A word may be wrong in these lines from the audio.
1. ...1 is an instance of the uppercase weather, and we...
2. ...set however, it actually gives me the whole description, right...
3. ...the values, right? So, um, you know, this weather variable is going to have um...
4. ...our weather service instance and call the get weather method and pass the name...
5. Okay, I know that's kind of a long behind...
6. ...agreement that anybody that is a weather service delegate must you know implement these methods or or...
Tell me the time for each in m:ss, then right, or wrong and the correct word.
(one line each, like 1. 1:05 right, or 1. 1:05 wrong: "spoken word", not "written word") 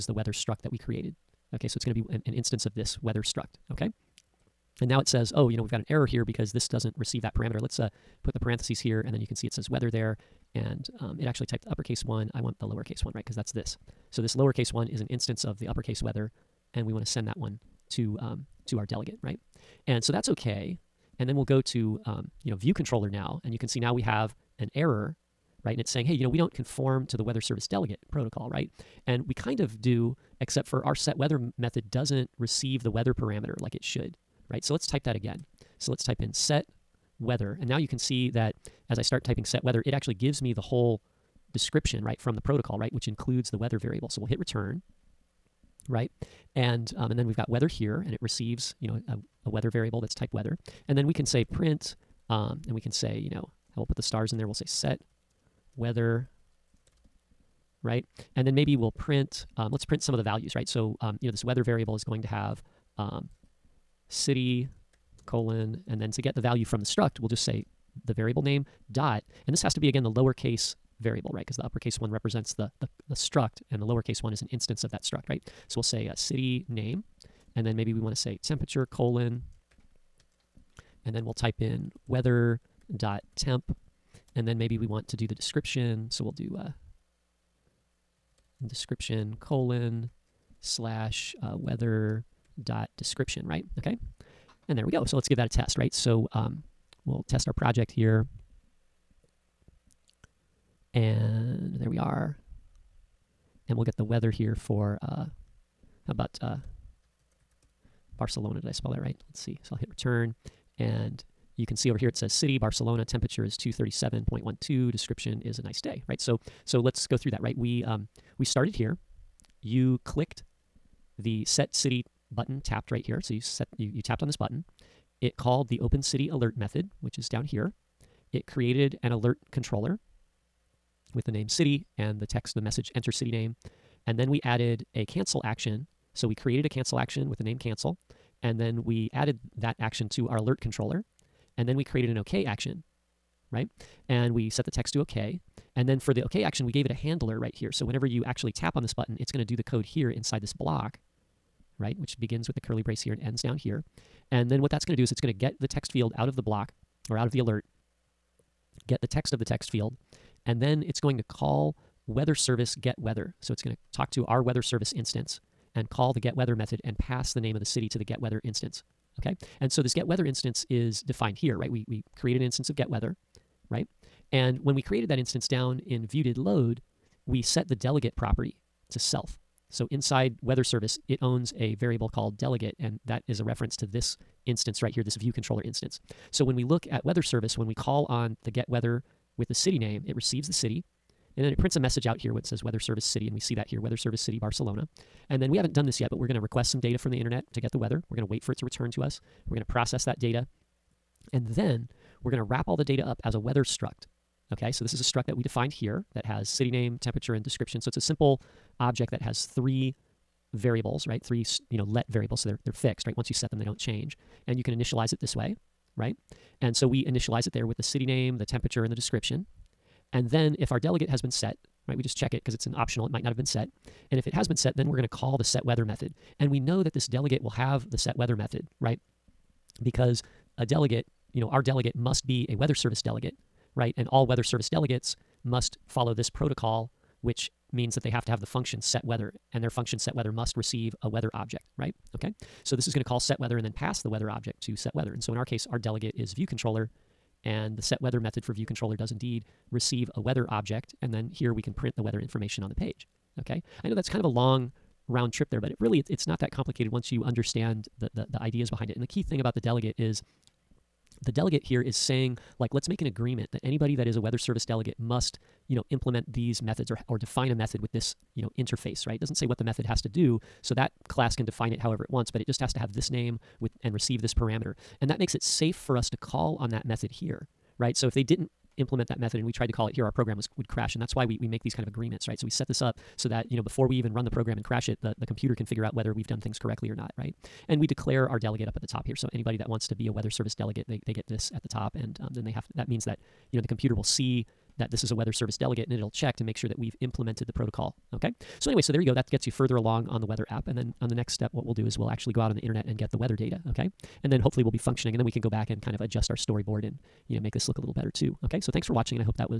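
1. 0:14 right
2. 0:39 wrong: "weather", not "however"
3. 1:00 right
4. 2:44 right
5. 4:13 wrong: "round", not "behind"
6. 4:23 right.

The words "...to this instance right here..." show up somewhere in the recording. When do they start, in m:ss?
3:03.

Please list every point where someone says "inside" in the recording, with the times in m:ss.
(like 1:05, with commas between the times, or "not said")
2:30, 2:59.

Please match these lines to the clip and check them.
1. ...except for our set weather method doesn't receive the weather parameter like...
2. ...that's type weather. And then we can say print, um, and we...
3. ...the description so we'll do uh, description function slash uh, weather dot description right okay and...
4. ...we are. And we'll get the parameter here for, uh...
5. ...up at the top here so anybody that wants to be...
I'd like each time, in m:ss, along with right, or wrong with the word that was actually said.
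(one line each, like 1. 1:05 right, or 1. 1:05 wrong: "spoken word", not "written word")
1. 0:30 right
2. 0:50 right
3. 1:25 wrong: "colon", not "function"
4. 1:41 wrong: "weather", not "parameter"
5. 4:48 right.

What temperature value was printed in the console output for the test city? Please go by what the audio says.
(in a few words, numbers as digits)
237.12.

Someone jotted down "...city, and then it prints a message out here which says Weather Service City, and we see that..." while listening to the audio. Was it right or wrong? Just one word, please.
right.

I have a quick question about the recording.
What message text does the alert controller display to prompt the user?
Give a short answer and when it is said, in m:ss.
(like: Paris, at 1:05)
enter city name, at 2:12.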